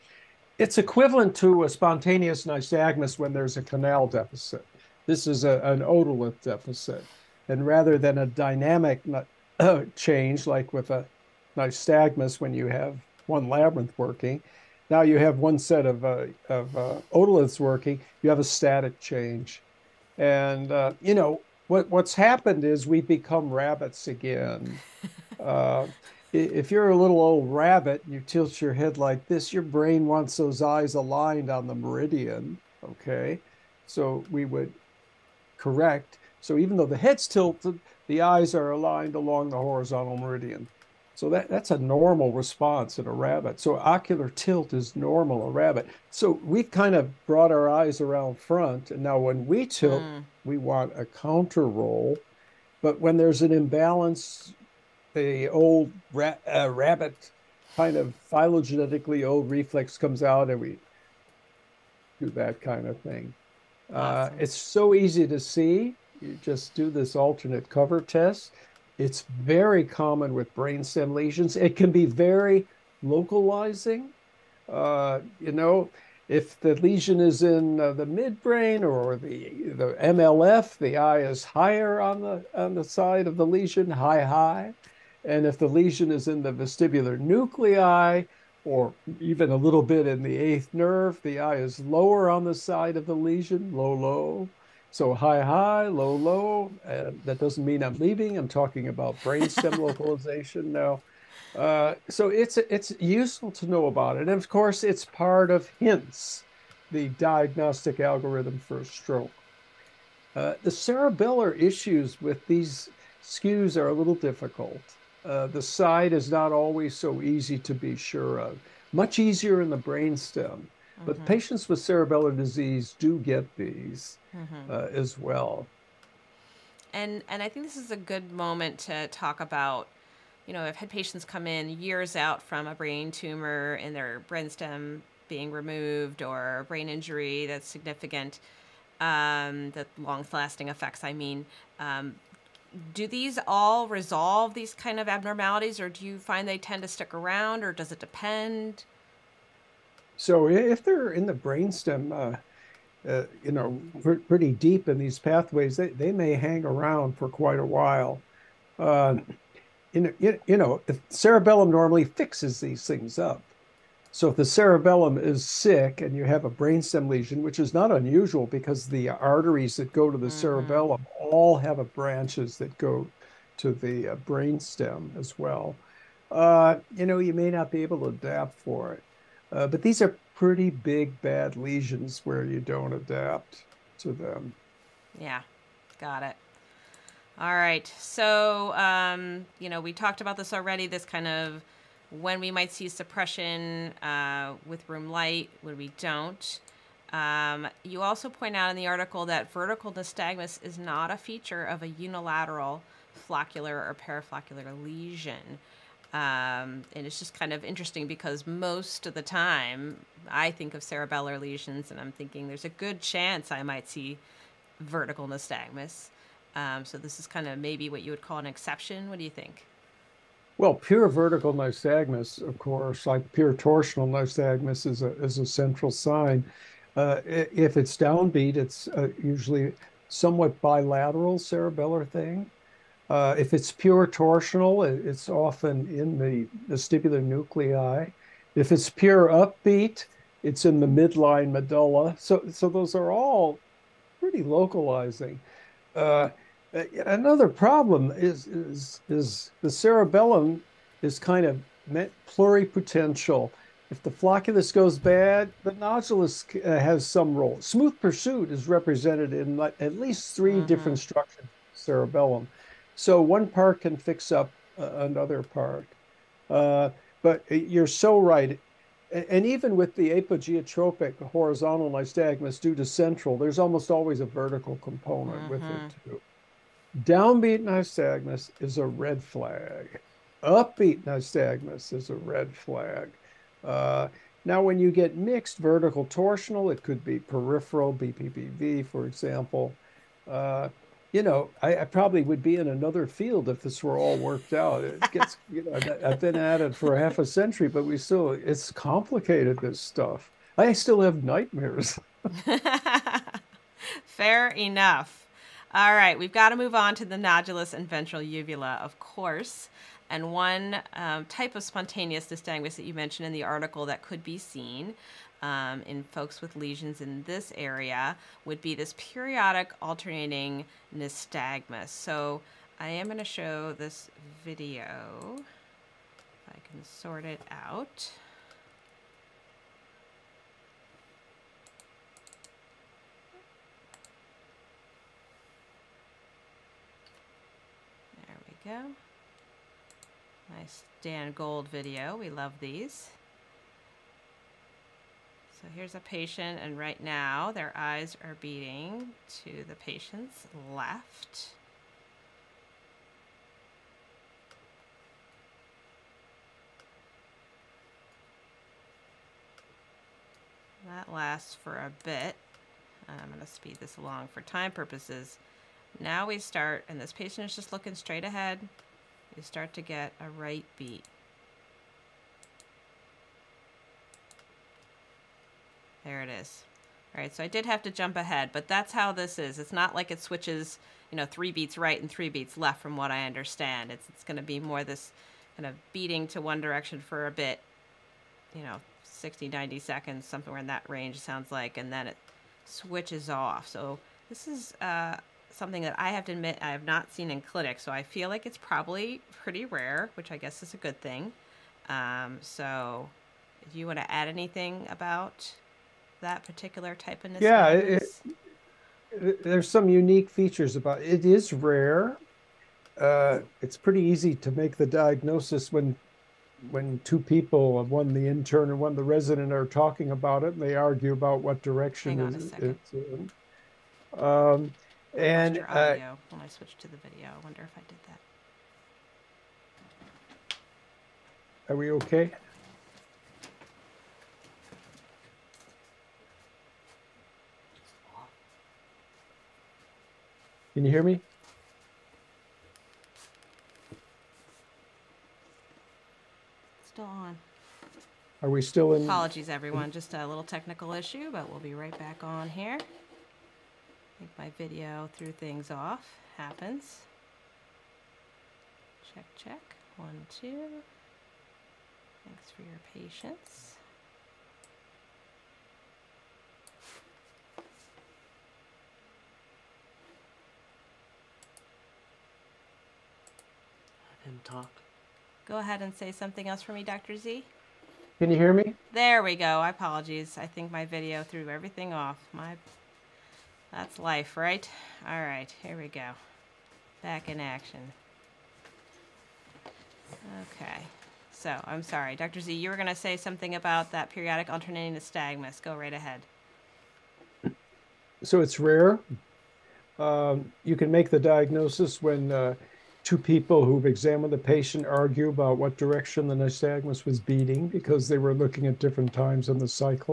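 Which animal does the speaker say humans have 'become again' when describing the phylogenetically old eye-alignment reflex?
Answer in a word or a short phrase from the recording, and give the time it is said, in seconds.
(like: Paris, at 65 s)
Rabbits, at 23 s.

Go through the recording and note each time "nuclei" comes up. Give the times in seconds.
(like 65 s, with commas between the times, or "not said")
87 s, 237 s.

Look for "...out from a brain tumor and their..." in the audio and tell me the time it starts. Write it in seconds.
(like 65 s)
132 s.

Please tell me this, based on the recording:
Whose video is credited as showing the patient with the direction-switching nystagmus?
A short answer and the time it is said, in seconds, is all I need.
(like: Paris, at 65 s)
Dan Gold, at 341 s.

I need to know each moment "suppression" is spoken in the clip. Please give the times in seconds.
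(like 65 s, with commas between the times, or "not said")
192 s.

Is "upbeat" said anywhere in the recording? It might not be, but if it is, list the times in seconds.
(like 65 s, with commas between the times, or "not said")
239 s, 280 s.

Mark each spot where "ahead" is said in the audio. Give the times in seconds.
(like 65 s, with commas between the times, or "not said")
368 s, 378 s, 475 s, 495 s.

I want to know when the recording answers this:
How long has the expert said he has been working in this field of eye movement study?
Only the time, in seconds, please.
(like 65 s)
296 s.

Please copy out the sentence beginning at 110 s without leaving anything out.
Uh, the cerebellar issues with these skews are a little difficult.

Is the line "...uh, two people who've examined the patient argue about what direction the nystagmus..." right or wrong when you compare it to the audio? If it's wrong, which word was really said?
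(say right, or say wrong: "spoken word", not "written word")
right.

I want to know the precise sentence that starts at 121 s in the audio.
patients with cerebellar disease do get these mm -hmm.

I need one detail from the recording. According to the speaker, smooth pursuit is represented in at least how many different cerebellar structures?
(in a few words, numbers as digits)
3.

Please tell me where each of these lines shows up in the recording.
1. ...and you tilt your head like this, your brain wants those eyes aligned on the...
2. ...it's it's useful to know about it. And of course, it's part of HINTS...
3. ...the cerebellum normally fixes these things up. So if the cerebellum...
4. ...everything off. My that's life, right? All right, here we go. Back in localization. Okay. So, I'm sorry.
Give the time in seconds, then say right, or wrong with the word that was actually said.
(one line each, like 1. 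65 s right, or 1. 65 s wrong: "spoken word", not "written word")
1. 28 s right
2. 102 s right
3. 160 s right
4. 481 s wrong: "action", not "localization".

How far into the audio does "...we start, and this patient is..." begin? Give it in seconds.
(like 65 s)
366 s.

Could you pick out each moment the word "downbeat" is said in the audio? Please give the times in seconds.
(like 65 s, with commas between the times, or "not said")
227 s, 277 s.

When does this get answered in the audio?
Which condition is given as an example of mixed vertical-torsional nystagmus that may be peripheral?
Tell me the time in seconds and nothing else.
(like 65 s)
287 s.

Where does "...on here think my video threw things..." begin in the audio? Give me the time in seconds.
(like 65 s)
452 s.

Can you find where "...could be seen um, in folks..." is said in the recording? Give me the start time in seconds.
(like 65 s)
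314 s.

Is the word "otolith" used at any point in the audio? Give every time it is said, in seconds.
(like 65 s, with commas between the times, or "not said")
5 s, 17 s.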